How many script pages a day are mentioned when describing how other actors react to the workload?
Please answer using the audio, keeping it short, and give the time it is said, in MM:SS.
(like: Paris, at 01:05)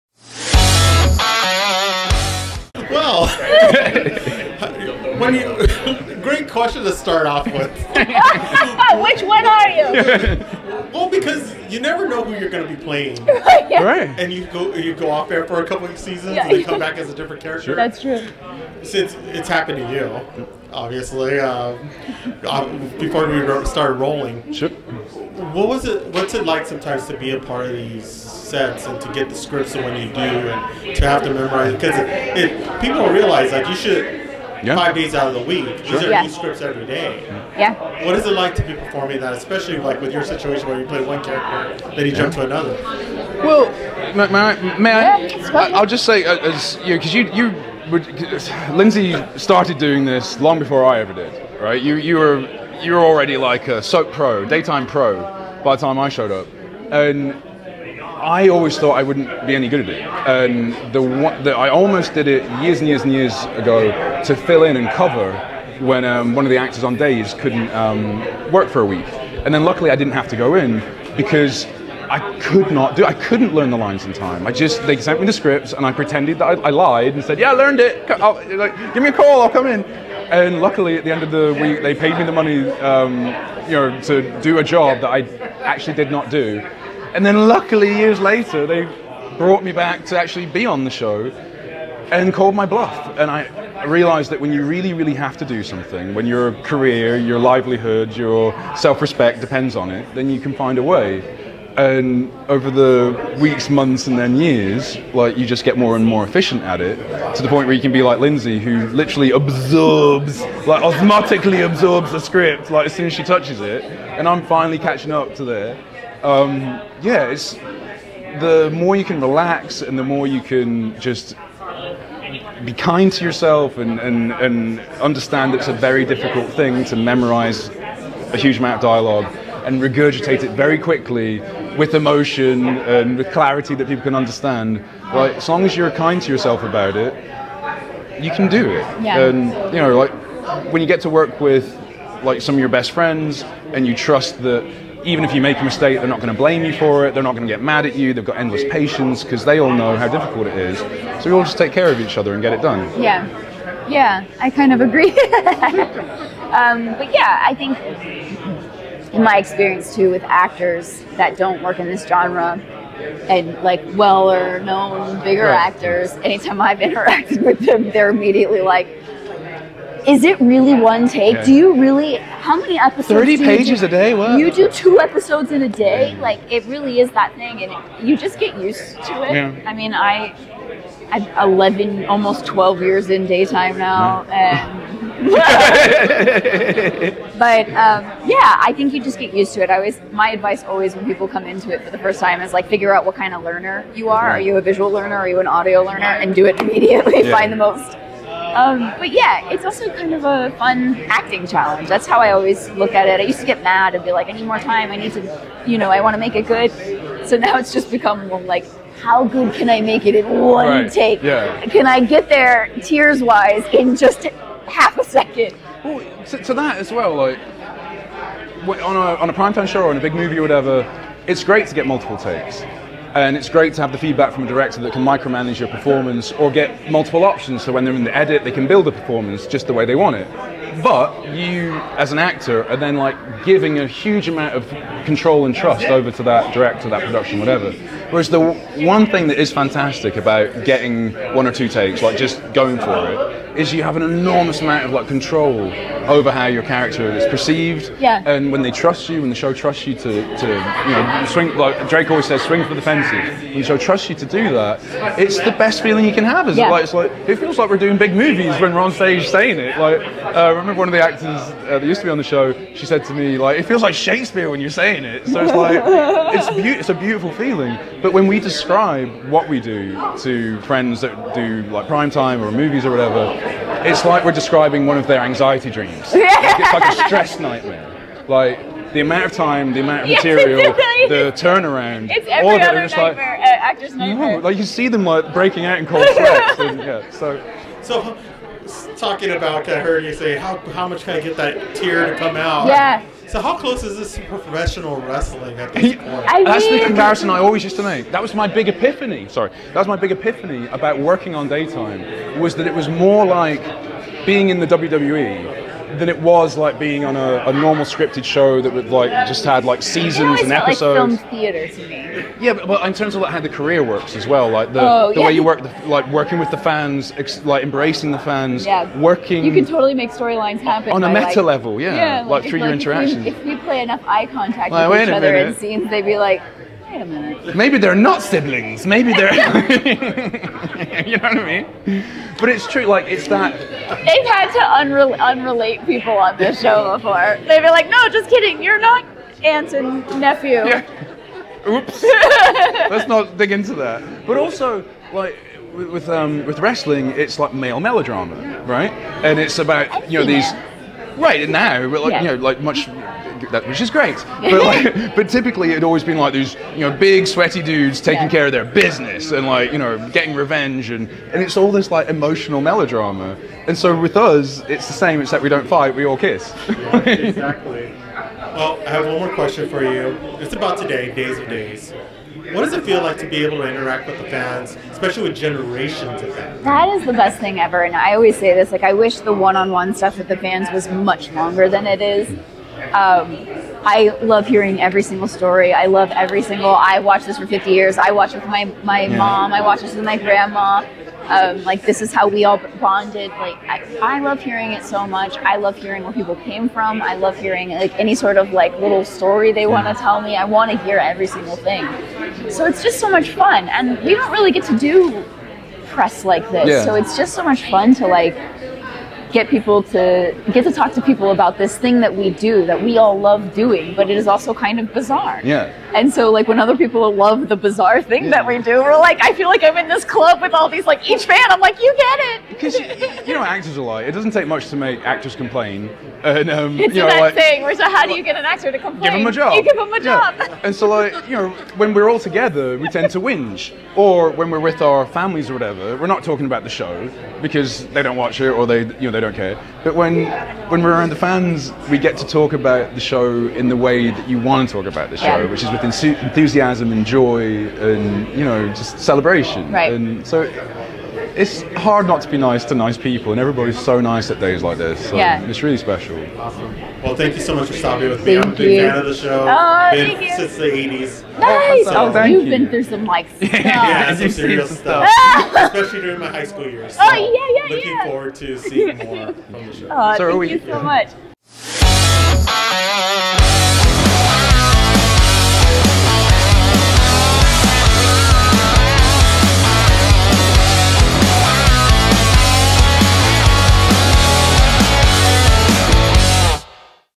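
30, at 02:53.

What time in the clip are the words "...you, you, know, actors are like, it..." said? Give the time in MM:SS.
07:02.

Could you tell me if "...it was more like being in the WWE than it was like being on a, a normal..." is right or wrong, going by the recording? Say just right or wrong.
right.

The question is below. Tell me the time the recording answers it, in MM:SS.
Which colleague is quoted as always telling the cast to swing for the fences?
04:11.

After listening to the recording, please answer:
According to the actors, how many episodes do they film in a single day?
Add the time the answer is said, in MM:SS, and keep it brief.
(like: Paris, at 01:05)
2, at 02:54.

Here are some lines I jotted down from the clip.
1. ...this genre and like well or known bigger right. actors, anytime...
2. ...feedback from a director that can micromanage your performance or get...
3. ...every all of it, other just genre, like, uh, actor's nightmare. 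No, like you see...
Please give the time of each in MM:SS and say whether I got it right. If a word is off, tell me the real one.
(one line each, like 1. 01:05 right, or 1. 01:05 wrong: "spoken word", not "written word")
1. 02:41 right
2. 03:43 right
3. 04:42 wrong: "nightmare", not "genre".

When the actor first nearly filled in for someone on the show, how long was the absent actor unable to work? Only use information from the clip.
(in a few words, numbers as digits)
A week.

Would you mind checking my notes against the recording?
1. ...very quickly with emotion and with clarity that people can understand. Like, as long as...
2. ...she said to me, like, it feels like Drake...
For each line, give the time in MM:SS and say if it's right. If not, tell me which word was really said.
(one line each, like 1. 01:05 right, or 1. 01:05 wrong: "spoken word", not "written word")
1. 02:10 right
2. 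04:22 wrong: "Shakespeare", not "Drake".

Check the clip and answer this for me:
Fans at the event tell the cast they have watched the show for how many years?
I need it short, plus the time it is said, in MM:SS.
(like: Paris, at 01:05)
50 years, at 06:27.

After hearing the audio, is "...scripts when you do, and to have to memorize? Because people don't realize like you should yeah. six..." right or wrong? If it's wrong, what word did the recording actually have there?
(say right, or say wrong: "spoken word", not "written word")
wrong: "five", not "six".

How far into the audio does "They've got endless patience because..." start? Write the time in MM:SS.
02:28.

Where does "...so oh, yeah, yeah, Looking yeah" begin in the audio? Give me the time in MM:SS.
07:47.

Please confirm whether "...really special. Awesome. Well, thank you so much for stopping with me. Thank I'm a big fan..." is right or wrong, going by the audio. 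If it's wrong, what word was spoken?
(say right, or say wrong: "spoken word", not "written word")
right.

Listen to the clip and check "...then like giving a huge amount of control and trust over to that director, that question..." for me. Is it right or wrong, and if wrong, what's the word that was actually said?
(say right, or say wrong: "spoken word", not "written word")
wrong: "production", not "question".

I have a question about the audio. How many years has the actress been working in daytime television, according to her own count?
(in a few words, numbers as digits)
Almost 12 years.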